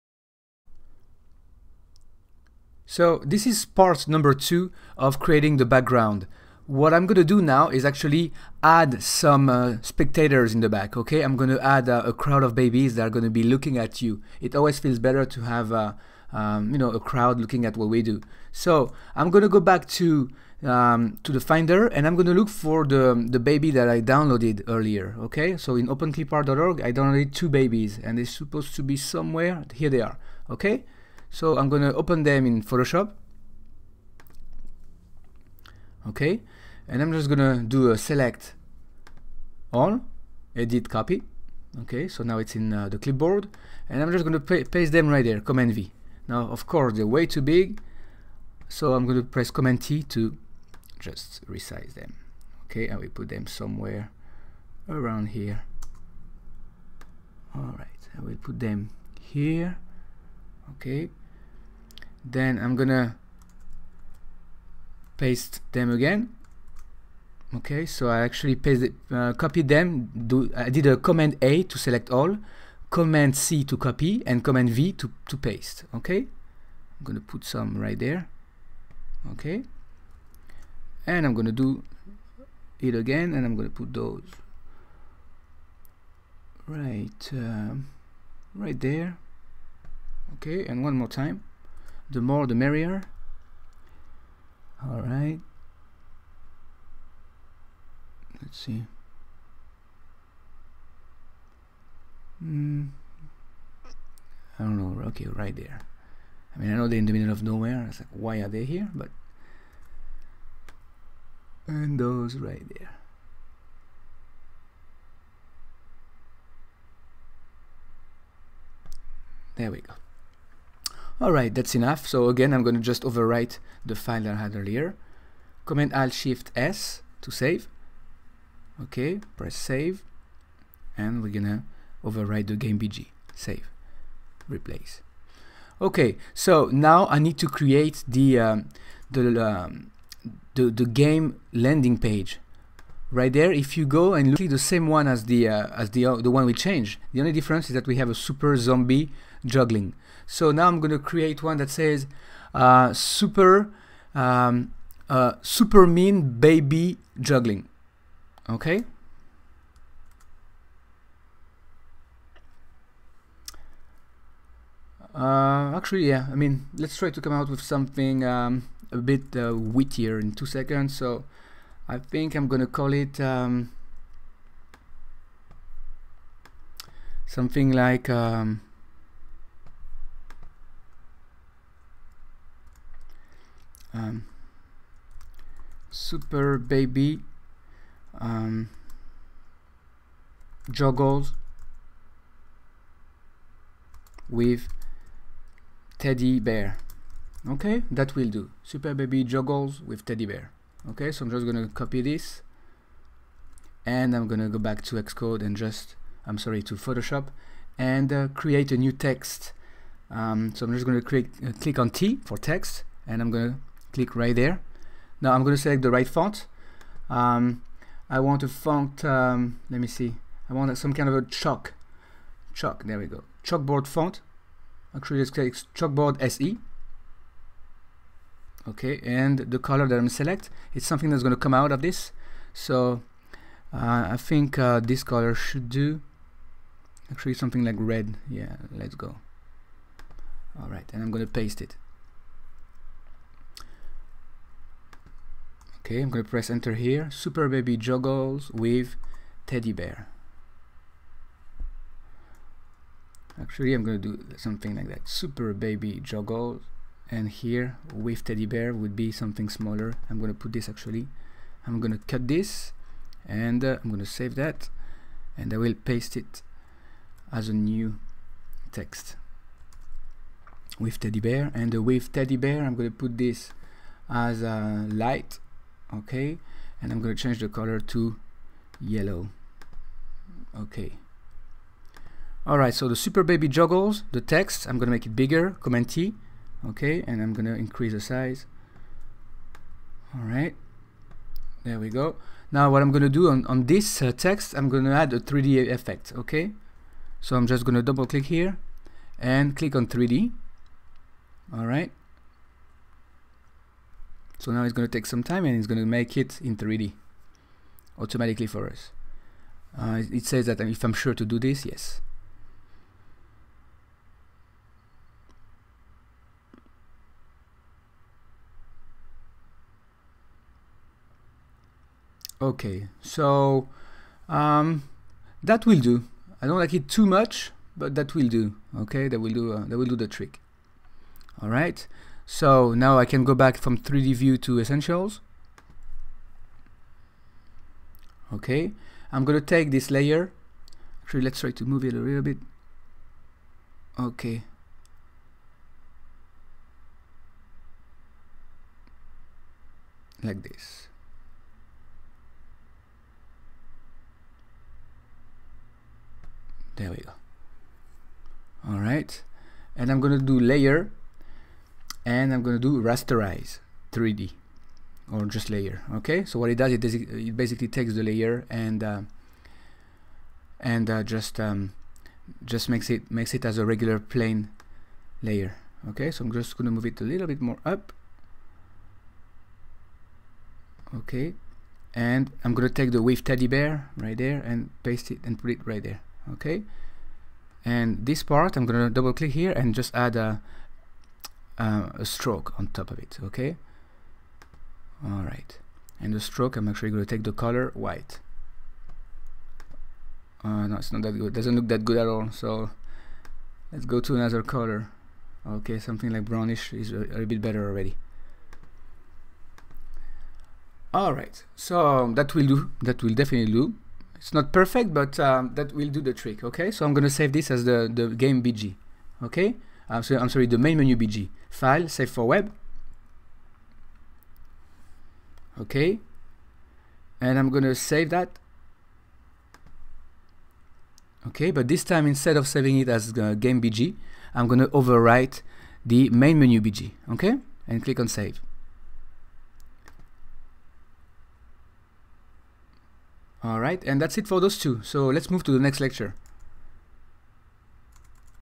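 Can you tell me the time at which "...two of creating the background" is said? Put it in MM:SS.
00:04.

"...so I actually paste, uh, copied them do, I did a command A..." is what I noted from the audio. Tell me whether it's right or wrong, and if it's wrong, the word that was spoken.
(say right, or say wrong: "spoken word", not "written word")
right.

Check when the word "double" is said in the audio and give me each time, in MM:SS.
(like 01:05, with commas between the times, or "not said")
04:57, 06:28.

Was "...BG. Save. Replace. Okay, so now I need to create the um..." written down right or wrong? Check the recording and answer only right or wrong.
right.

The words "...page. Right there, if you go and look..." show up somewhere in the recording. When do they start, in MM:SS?
02:21.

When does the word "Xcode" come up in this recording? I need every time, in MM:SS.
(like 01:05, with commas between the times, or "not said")
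03:24.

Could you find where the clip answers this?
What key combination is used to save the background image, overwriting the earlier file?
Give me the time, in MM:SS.
02:05.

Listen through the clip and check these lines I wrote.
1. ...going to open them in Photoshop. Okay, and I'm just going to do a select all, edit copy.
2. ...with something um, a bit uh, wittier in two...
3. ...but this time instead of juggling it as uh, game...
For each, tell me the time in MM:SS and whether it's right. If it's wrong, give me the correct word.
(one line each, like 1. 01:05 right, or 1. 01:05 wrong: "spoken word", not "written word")
1. 00:31 right
2. 02:47 right
3. 07:11 wrong: "saving", not "juggling".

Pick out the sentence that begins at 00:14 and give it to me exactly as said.
It always feels better to have uh, um, you know, a crowd looking at what we do.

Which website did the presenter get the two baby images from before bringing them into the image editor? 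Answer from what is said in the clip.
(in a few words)
OpenClipArt.org.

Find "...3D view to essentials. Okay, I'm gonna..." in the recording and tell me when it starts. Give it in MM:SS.
05:33.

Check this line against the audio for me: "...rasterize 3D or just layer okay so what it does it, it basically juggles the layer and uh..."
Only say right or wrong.
wrong.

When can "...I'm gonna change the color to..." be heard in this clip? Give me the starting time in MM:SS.
04:36.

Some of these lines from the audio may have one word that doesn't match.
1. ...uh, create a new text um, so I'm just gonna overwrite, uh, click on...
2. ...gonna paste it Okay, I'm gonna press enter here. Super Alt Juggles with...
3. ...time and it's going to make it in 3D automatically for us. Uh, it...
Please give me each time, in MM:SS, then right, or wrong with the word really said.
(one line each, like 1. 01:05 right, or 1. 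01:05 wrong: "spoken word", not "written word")
1. 03:28 wrong: "create", not "overwrite"
2. 04:01 wrong: "Baby", not "Alt"
3. 05:05 right.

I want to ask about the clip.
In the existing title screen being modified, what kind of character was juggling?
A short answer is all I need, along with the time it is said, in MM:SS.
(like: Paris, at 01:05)
super zombie, at 02:28.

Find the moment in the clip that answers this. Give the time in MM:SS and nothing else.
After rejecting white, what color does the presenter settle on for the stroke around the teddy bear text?
06:46.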